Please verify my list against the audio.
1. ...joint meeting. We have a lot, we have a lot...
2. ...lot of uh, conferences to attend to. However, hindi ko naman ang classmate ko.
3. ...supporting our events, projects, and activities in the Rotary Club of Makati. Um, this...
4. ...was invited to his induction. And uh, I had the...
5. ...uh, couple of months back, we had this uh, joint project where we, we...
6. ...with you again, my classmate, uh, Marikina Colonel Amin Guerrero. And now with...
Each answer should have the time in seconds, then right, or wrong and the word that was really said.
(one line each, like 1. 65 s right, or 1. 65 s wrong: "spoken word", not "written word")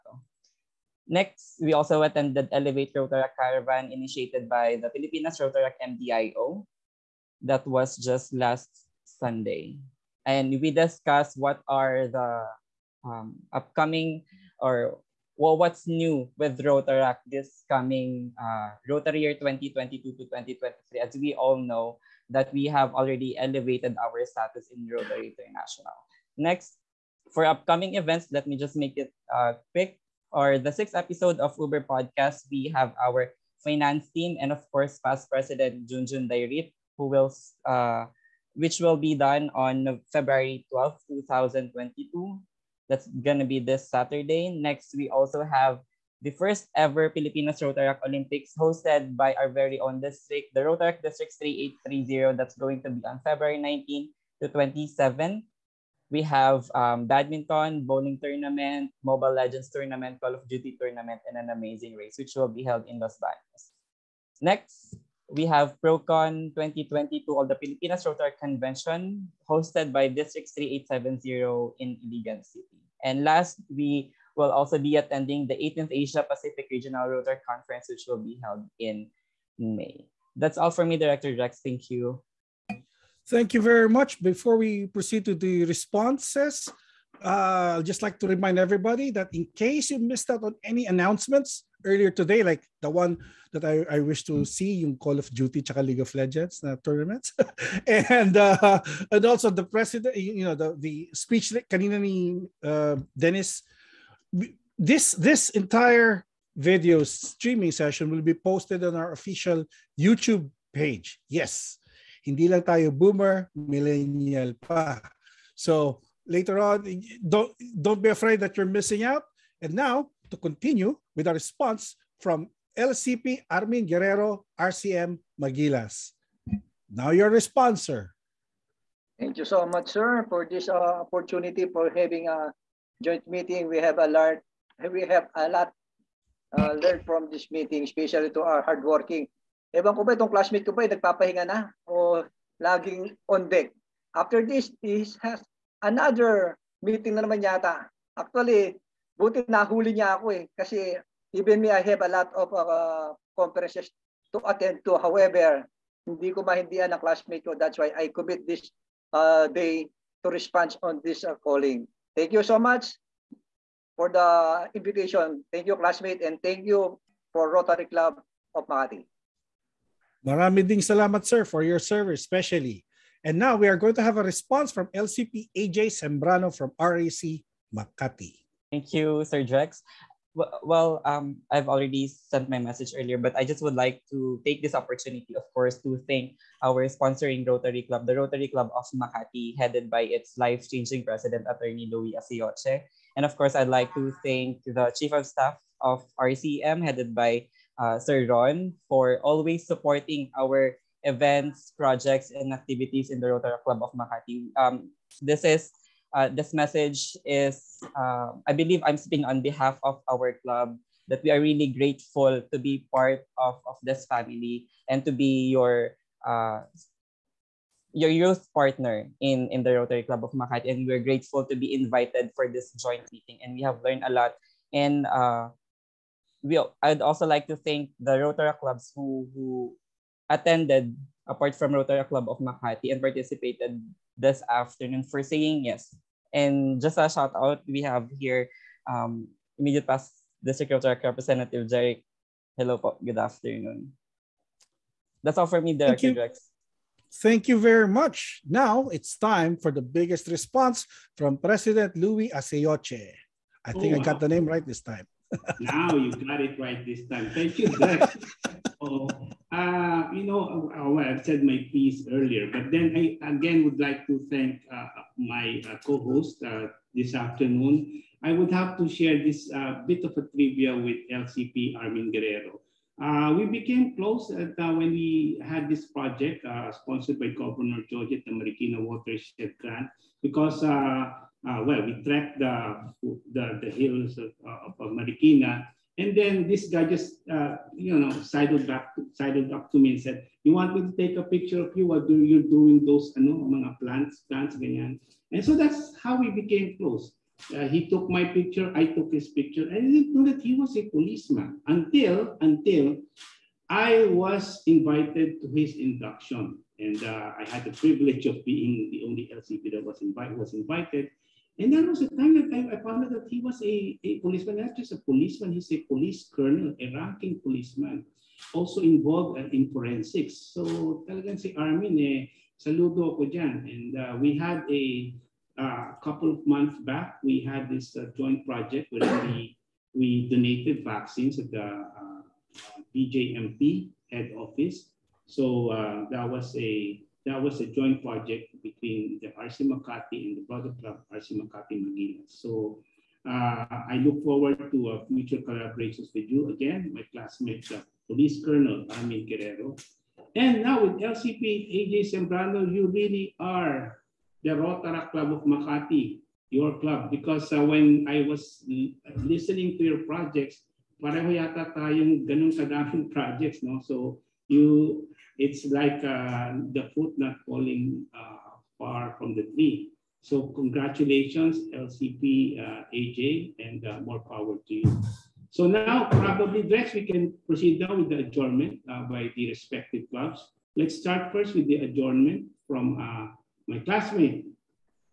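1. 133 s right
2. 152 s wrong: "mahindihan", not "naman"
3. 199 s right
4. 304 s right
5. 325 s right
6. 346 s wrong: "Police", not "Marikina".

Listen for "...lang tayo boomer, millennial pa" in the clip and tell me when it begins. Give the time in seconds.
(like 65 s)
112 s.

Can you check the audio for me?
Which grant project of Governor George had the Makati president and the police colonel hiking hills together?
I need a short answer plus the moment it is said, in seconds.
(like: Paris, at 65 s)
Marikina Watershed Grant, at 278 s.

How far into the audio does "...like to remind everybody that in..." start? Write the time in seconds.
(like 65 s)
88 s.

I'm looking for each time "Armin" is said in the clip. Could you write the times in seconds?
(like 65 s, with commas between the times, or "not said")
123 s, 271 s, 321 s.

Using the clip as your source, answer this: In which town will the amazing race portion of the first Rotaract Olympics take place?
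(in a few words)
Los Baños.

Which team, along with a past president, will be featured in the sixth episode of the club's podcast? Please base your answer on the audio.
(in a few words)
finance team.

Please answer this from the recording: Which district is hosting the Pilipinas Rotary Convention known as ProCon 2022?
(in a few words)
District 3870.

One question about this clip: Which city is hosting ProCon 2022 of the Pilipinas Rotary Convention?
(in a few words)
Iligan City.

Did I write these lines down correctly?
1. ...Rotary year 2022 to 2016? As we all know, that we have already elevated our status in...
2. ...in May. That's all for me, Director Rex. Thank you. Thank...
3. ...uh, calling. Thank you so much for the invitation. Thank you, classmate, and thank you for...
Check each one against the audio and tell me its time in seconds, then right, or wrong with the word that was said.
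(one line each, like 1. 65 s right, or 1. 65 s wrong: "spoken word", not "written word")
1. 18 s wrong: "2023", not "2016"
2. 78 s right
3. 161 s right.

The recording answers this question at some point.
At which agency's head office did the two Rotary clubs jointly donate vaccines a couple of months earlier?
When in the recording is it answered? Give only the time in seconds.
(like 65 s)
332 s.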